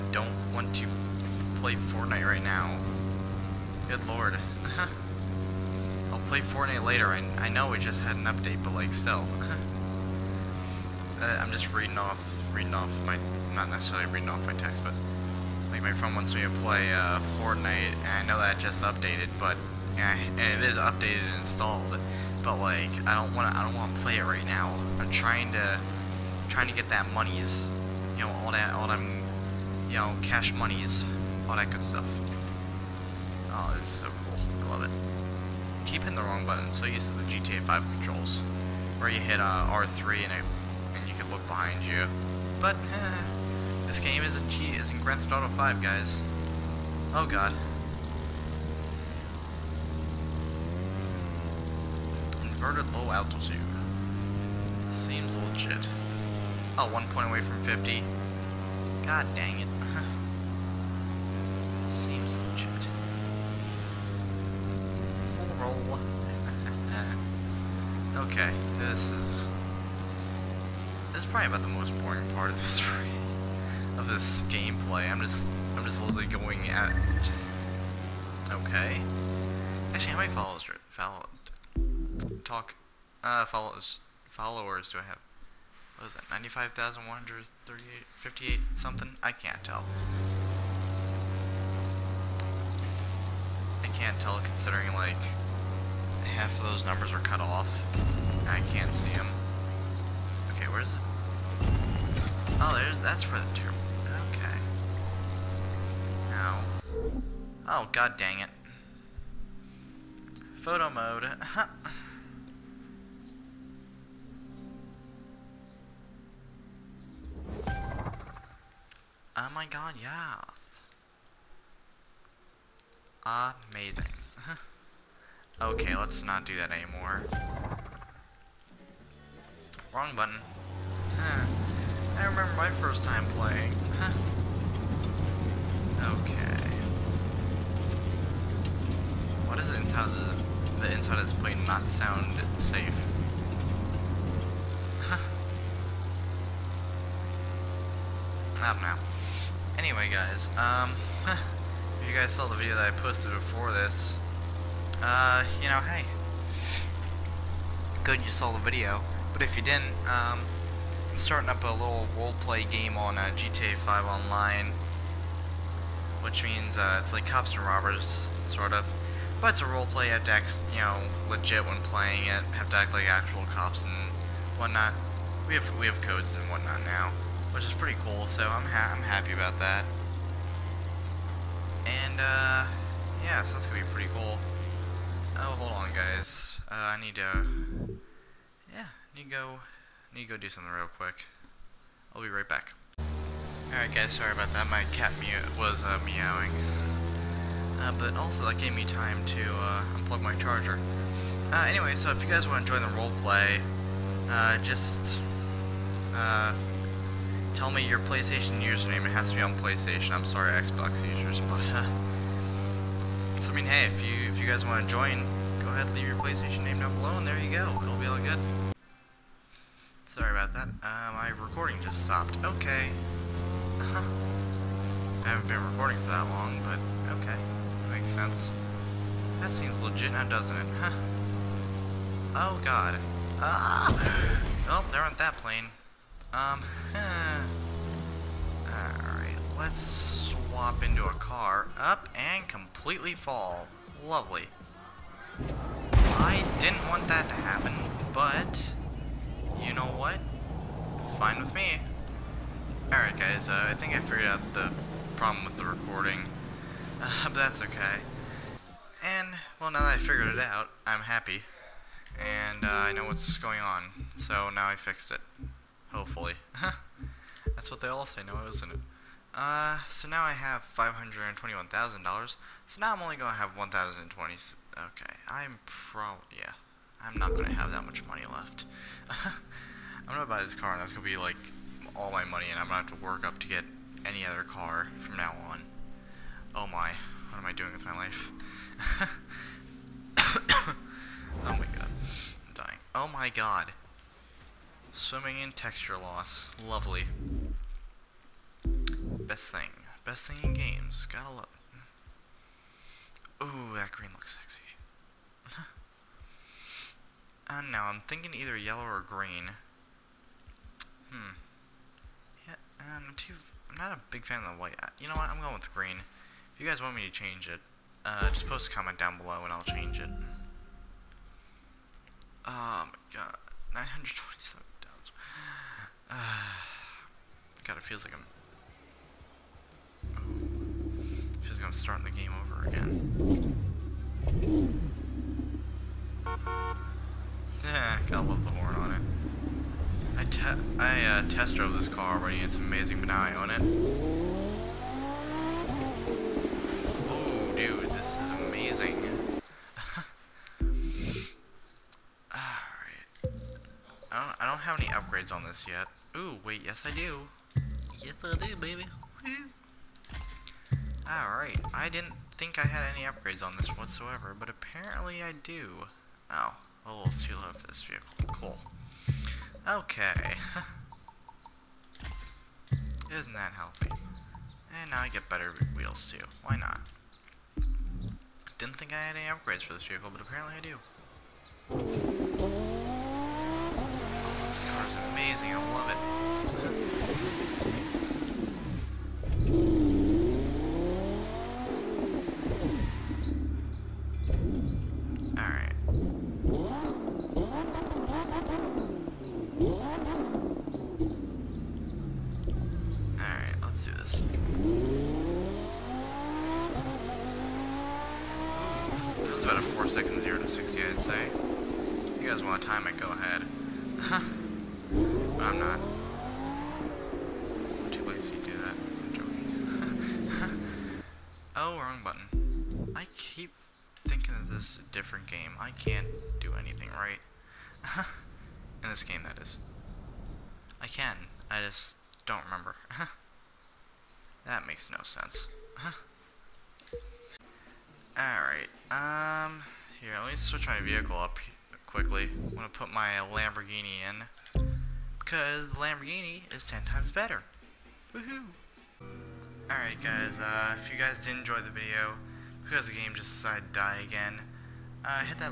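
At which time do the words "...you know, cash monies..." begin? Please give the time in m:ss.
0:29.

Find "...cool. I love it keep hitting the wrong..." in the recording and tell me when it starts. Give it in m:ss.
0:34.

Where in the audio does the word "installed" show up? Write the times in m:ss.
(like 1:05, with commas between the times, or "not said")
0:21.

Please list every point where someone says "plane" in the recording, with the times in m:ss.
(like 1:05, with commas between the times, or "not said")
2:21, 3:55.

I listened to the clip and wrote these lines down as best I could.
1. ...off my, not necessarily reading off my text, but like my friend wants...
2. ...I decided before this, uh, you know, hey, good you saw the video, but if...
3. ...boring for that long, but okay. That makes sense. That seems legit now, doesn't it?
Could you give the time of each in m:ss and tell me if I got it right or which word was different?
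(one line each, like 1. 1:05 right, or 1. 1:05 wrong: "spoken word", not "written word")
1. 0:12 right
2. 2:32 wrong: "posted", not "decided"
3. 3:45 wrong: "recording", not "boring".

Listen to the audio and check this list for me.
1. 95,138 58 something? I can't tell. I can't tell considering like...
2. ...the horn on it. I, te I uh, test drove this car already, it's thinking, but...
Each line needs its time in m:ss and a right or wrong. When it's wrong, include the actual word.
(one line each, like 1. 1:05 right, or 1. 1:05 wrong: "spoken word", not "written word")
1. 1:26 right
2. 5:38 wrong: "amazing", not "thinking".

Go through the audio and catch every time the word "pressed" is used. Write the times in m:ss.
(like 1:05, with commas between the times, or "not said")
not said.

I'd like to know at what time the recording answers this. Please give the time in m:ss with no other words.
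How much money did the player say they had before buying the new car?
4:30.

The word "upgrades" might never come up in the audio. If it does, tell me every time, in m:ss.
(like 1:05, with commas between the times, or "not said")
5:54, 6:03, 6:19.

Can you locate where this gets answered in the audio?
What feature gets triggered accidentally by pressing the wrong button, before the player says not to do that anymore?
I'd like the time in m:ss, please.
1:50.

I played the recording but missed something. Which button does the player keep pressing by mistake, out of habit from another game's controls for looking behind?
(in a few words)
R3.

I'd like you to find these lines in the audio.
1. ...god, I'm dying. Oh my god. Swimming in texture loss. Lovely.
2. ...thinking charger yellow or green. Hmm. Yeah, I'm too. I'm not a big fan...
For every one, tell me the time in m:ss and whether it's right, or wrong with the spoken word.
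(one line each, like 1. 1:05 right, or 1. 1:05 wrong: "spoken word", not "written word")
1. 4:51 right
2. 5:08 wrong: "either", not "charger".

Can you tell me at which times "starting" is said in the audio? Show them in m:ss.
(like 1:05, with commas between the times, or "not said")
2:41, 5:31.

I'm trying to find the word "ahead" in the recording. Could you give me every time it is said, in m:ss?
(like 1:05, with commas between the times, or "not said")
3:35.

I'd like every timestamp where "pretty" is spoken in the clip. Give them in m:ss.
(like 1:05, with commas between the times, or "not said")
2:57, 3:03.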